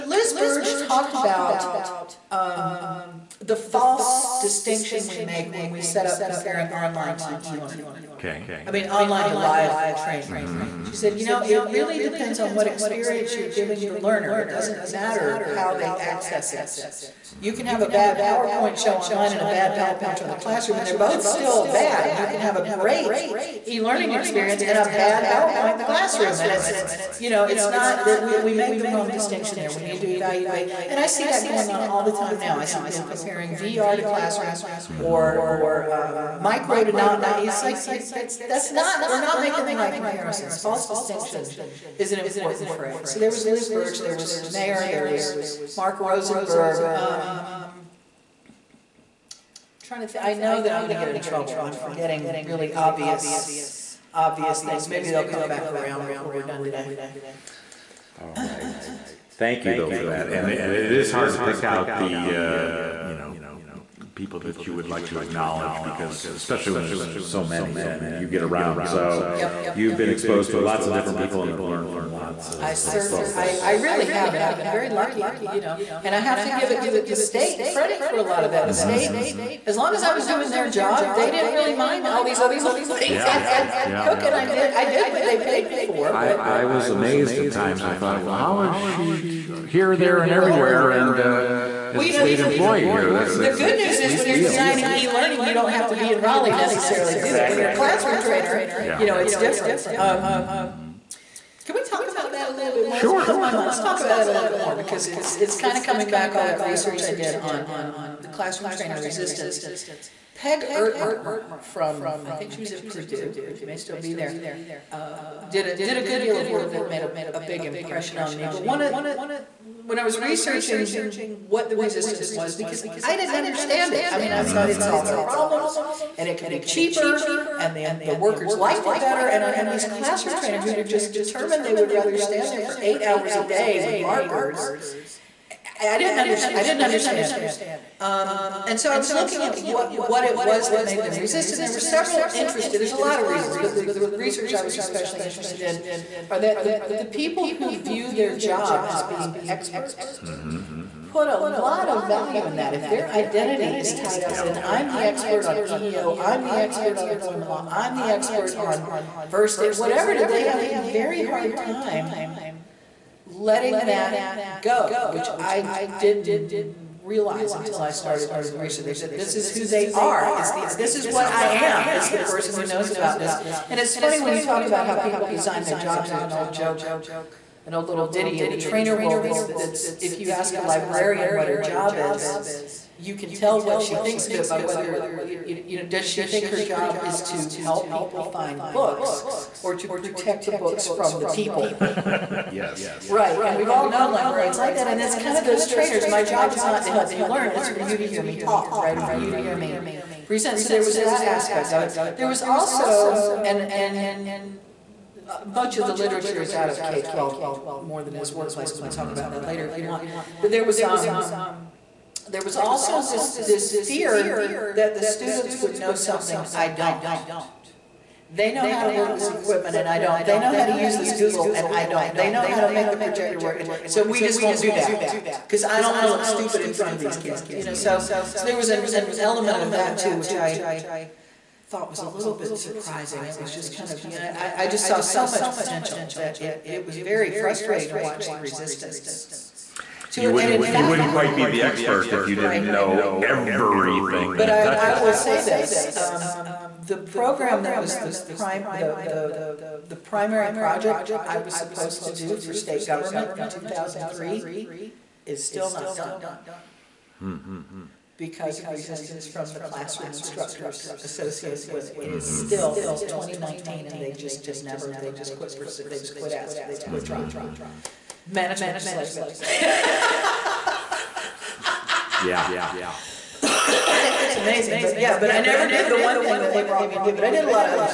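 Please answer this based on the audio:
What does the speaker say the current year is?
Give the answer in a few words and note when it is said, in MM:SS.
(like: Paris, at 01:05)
2019, at 04:23.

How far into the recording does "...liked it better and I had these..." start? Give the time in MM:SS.
02:08.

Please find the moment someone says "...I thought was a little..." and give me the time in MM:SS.
03:50.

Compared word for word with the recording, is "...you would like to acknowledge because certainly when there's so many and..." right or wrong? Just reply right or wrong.
wrong.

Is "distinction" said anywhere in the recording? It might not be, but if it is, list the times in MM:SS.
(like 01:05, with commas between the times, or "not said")
00:04, 00:29, 00:40.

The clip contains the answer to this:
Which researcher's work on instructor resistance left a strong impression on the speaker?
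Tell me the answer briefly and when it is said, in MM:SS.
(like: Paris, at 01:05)
Peg Ertmer, at 01:50.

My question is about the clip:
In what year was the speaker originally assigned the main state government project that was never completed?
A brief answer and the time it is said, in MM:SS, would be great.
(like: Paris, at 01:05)
2003, at 04:13.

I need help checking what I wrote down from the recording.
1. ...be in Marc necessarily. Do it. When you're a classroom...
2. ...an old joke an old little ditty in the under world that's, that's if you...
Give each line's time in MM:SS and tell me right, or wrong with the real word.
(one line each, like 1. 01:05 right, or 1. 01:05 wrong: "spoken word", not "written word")
1. 01:35 wrong: "Raleigh", not "Marc"
2. 02:56 wrong: "trainer", not "under".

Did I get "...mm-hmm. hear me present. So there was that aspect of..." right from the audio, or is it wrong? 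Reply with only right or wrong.
right.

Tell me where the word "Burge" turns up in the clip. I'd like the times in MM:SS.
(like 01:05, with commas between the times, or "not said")
00:00, 00:43.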